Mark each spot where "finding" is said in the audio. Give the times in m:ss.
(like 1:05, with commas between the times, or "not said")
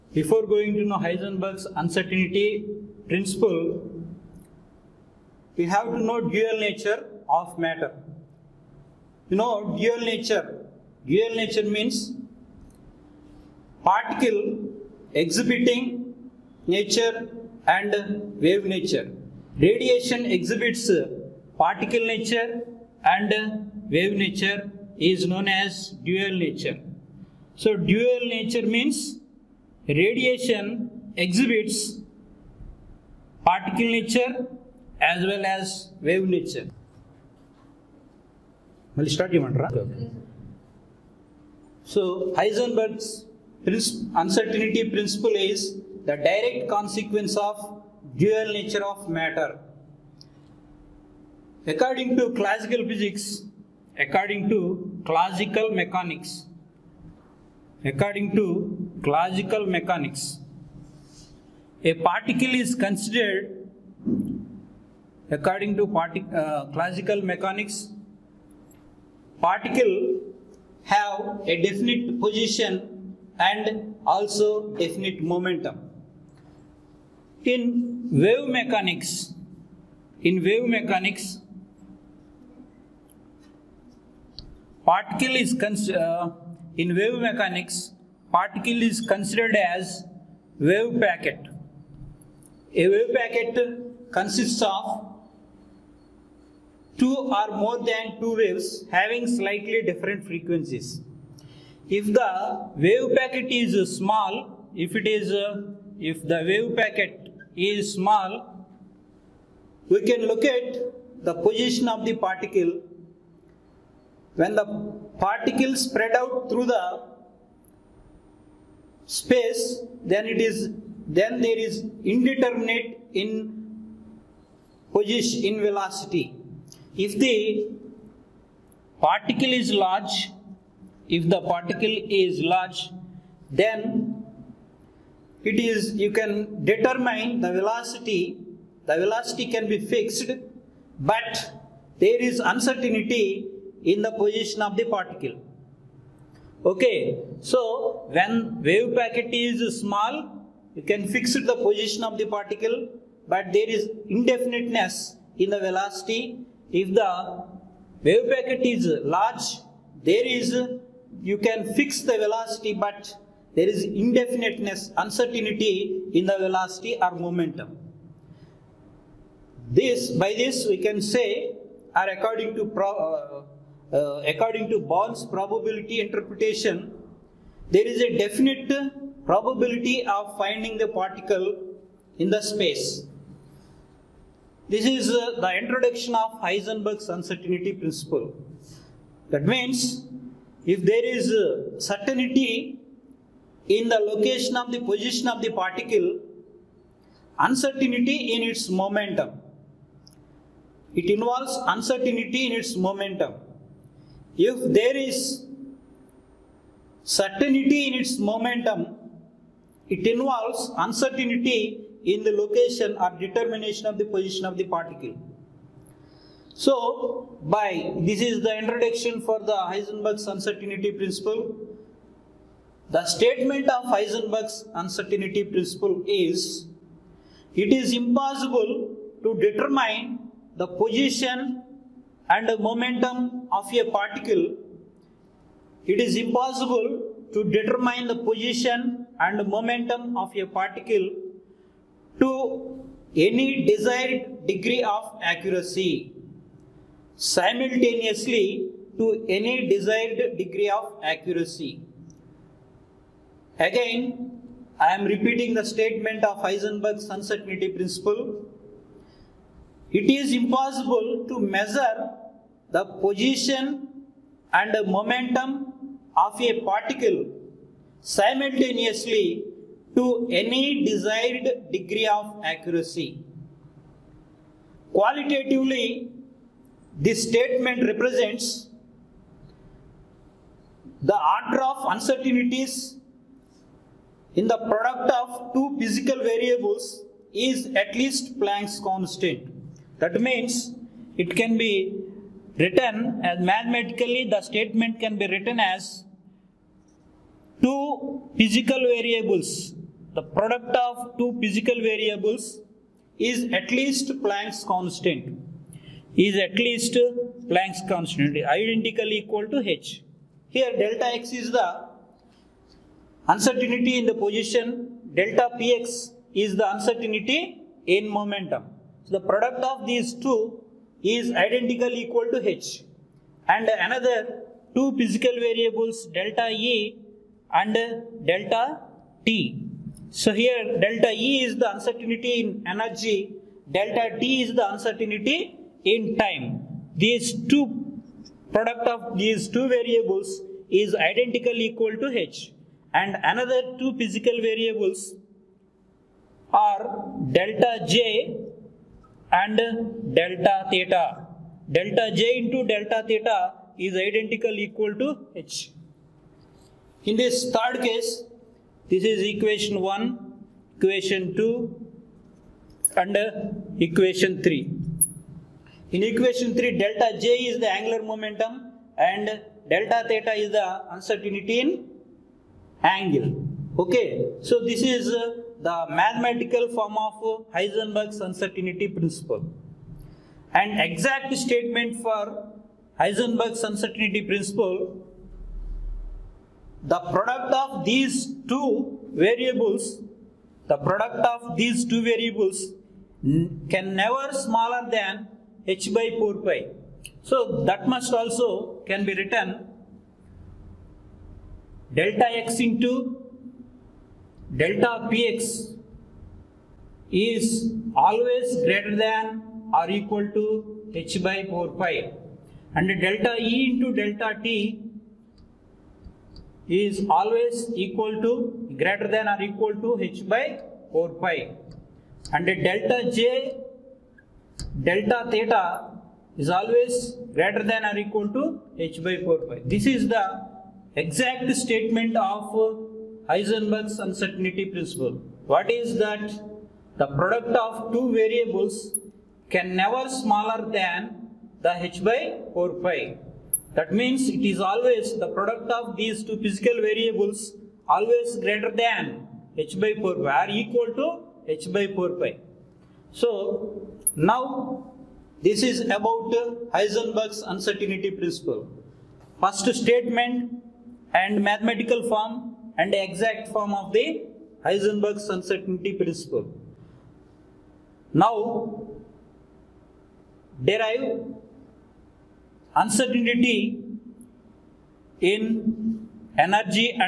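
3:00.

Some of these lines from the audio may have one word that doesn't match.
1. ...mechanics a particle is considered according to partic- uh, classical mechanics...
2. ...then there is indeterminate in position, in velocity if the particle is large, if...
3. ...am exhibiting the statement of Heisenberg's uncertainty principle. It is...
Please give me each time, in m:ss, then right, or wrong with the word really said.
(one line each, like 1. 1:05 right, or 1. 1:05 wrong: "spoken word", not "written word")
1. 0:59 right
2. 2:01 right
3. 4:14 wrong: "repeating", not "exhibiting".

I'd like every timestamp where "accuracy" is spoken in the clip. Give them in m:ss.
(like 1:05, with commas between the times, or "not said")
4:05, 4:11, 4:32.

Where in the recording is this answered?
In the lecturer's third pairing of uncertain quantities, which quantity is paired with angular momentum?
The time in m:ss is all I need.
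6:10.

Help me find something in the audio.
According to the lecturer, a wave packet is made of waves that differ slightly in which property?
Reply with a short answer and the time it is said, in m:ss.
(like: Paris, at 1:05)
frequencies, at 1:38.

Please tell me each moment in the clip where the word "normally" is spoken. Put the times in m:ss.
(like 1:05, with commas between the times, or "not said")
not said.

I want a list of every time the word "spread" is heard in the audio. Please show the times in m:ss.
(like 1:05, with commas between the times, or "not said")
1:55.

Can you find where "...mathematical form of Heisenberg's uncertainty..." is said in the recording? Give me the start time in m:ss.
6:15.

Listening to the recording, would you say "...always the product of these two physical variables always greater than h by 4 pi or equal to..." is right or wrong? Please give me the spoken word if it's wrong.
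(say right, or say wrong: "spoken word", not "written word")
right.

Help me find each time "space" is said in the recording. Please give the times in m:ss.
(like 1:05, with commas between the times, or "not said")
1:59, 3:02.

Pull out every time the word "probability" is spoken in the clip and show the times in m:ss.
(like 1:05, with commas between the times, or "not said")
2:55, 2:59.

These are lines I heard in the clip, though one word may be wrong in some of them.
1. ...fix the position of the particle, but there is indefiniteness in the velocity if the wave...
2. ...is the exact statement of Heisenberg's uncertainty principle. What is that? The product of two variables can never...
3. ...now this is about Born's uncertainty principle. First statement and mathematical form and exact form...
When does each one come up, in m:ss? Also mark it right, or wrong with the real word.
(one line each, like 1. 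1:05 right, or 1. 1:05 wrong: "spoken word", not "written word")
1. 2:31 right
2. 7:09 right
3. 7:34 wrong: "Heisenberg", not "Born".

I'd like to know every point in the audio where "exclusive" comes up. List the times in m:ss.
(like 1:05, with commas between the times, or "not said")
not said.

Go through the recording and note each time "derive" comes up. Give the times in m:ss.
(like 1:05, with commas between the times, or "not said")
7:50.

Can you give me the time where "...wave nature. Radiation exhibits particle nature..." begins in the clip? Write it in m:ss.
0:18.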